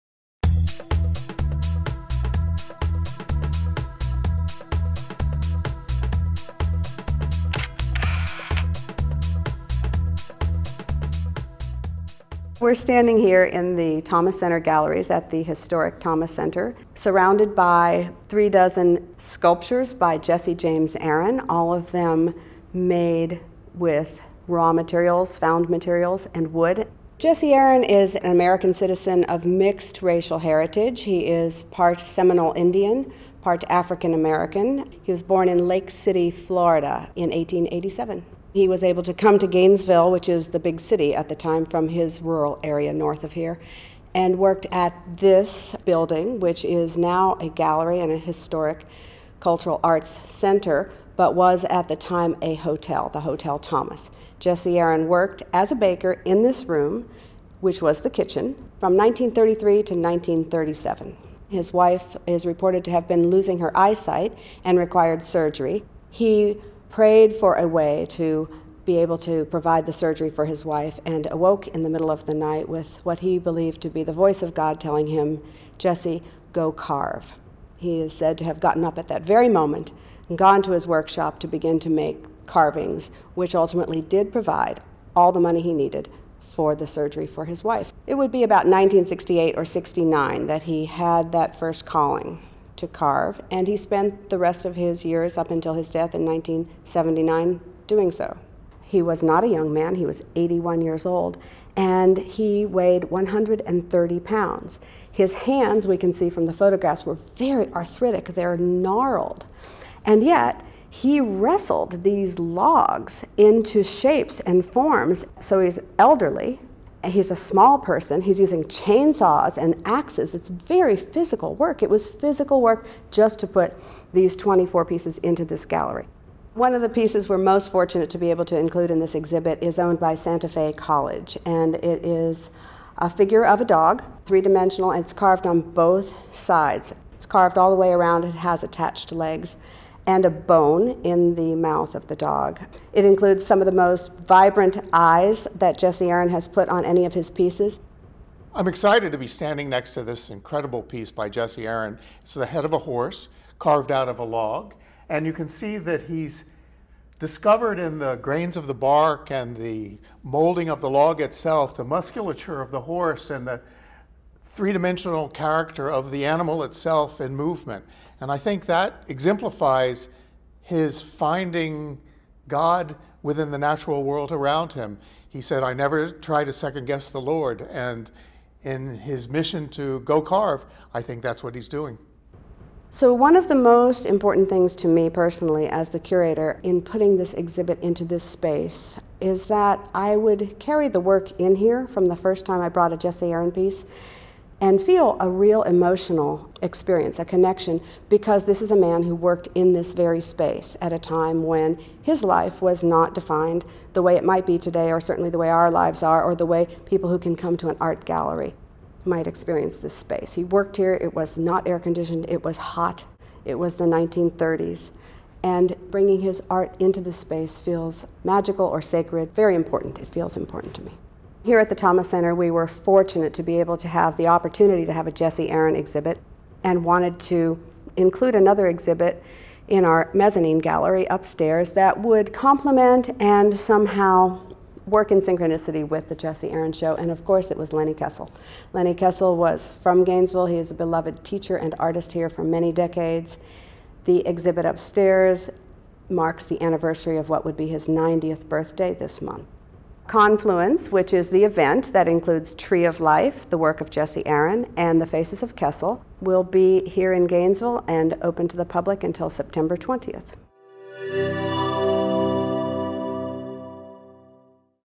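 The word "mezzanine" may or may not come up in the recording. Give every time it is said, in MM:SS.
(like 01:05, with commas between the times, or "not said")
03:50.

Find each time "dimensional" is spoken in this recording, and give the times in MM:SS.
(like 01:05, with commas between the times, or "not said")
02:14, 02:44.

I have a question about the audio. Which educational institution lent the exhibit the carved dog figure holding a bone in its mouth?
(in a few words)
Santa Fe College.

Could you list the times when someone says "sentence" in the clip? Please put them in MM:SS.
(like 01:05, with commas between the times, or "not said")
not said.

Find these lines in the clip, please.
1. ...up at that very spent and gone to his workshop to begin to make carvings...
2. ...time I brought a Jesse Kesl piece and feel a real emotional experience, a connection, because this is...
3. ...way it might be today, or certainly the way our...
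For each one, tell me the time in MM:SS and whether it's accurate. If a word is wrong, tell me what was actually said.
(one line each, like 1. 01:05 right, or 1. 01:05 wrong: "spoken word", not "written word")
1. 01:18 wrong: "moment", not "spent"
2. 03:12 wrong: "Aaron", not "Kesl"
3. 03:24 right.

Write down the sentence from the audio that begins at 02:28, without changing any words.
I'm excited to be standing next to this incredible piece by Jesse Aaron.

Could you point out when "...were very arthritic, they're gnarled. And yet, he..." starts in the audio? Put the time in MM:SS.
01:47.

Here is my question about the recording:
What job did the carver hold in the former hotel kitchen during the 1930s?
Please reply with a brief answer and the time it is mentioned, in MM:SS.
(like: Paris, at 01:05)
Baker, at 00:55.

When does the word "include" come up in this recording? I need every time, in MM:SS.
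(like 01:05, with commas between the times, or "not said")
02:08, 02:23, 03:47, 04:12.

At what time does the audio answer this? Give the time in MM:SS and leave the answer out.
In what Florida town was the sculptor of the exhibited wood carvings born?
00:35.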